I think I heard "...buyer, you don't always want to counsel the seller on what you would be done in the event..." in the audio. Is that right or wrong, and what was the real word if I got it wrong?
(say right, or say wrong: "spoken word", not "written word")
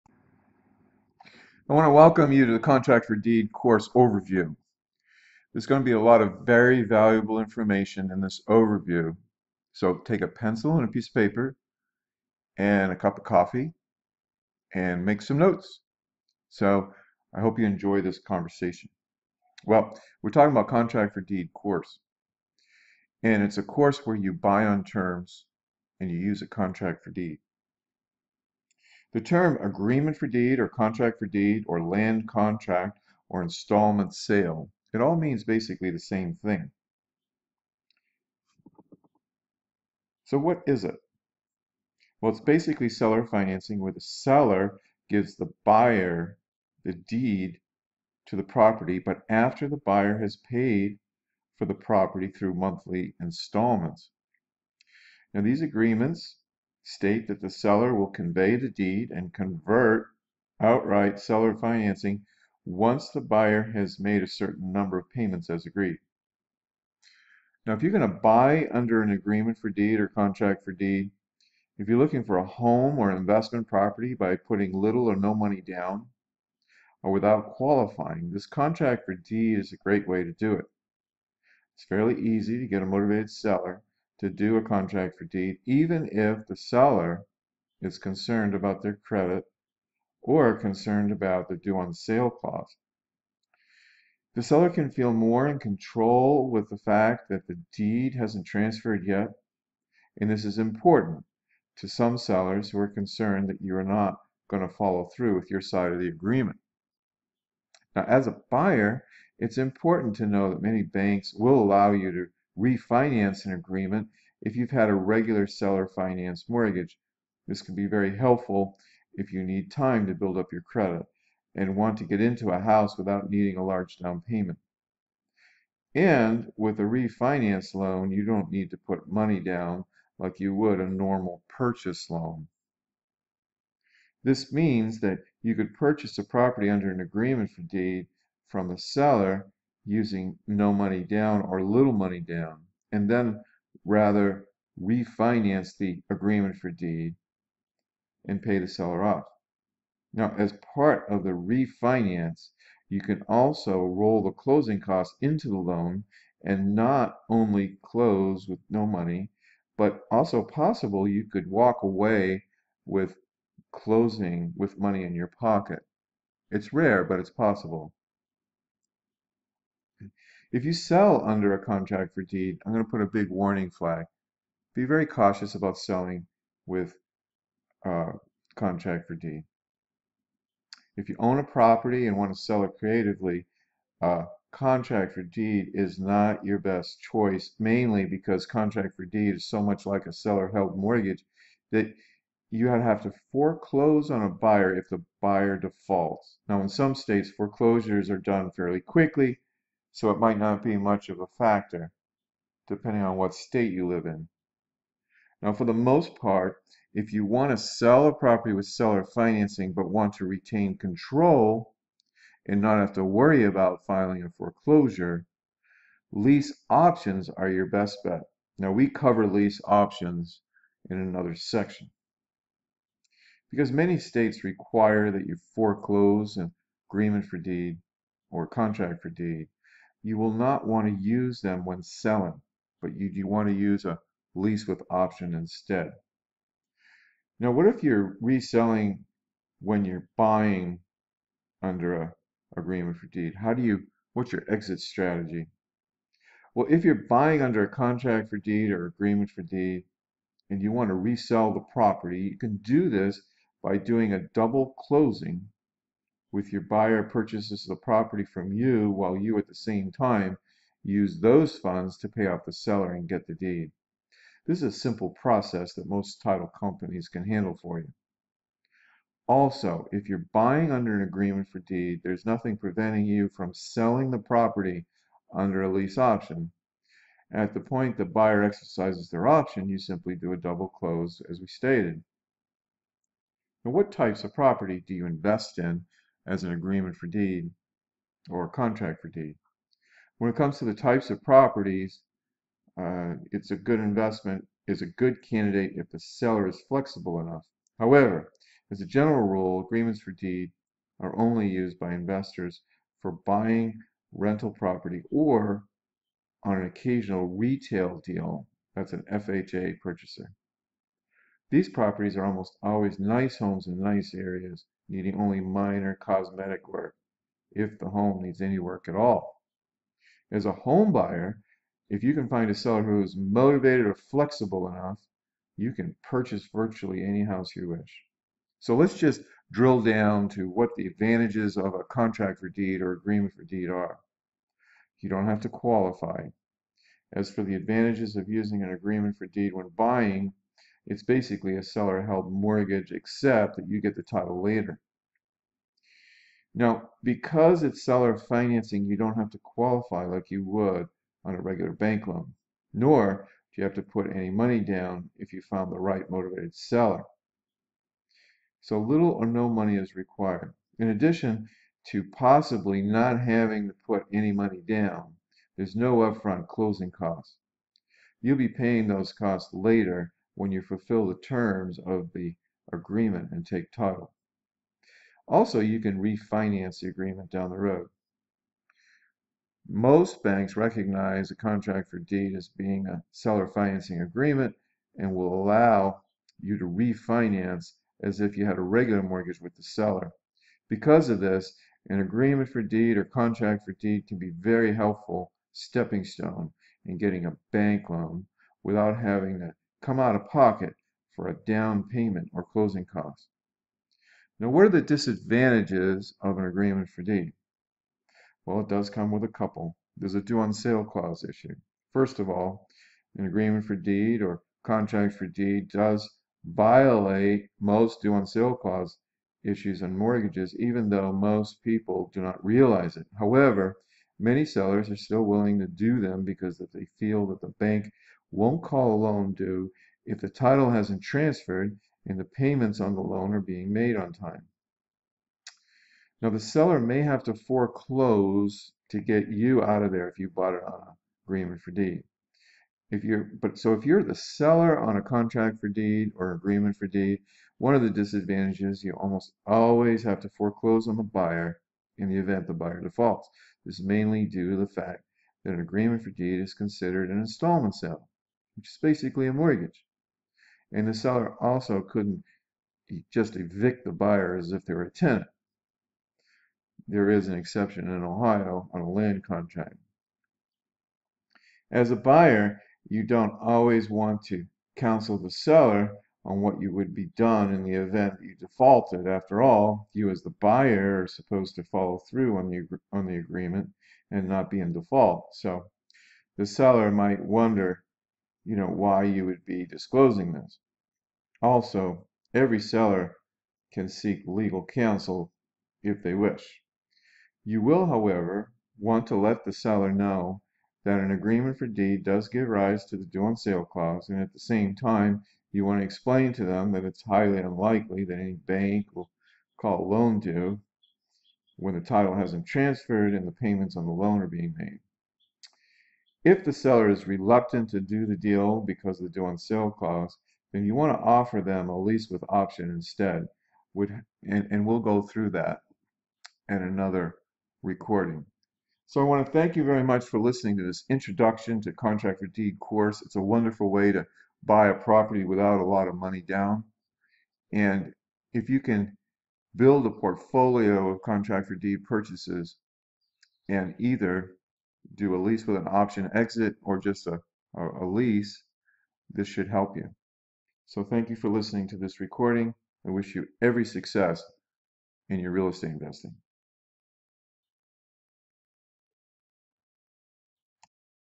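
right.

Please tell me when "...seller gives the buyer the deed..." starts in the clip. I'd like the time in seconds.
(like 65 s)
43 s.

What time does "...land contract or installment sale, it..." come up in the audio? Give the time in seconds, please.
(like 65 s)
31 s.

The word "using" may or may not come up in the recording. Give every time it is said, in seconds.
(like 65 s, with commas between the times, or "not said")
139 s, 338 s.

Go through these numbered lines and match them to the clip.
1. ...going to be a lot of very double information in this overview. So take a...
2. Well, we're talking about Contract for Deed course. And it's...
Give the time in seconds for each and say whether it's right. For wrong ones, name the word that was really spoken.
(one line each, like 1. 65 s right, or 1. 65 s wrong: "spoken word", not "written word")
1. 5 s wrong: "valuable", not "double"
2. 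19 s right.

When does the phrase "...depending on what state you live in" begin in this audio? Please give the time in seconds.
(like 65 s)
202 s.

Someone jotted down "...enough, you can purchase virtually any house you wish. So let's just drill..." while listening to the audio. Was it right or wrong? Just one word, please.
right.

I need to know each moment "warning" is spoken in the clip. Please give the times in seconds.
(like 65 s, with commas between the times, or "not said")
173 s.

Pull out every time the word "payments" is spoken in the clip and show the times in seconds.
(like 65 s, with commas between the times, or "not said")
65 s, 124 s, 401 s, 432 s, 513 s.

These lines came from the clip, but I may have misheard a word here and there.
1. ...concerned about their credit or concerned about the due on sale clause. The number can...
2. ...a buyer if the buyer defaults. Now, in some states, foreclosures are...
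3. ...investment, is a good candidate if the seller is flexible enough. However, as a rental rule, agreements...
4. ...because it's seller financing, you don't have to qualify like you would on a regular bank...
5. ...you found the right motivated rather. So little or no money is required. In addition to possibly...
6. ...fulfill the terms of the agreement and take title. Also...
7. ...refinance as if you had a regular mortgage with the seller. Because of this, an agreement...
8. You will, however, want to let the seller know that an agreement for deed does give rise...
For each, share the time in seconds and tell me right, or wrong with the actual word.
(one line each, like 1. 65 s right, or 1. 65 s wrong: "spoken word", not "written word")
1. 87 s wrong: "seller", not "number"
2. 194 s right
3. 293 s wrong: "general", not "rental"
4. 347 s right
5. 355 s wrong: "seller", not "rather"
6. 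370 s right
7. 386 s right
8. 497 s right.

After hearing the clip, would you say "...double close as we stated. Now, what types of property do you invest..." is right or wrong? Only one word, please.
right.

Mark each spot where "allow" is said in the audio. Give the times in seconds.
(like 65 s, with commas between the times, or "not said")
111 s, 385 s.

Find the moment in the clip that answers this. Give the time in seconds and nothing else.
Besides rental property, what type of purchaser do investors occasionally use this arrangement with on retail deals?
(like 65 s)
309 s.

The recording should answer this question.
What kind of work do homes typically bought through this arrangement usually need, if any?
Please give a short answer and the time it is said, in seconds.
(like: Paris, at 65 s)
minor cosmetic work, at 315 s.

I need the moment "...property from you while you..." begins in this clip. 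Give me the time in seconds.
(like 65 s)
257 s.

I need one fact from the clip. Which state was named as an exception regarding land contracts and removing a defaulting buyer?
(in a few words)
Ohio.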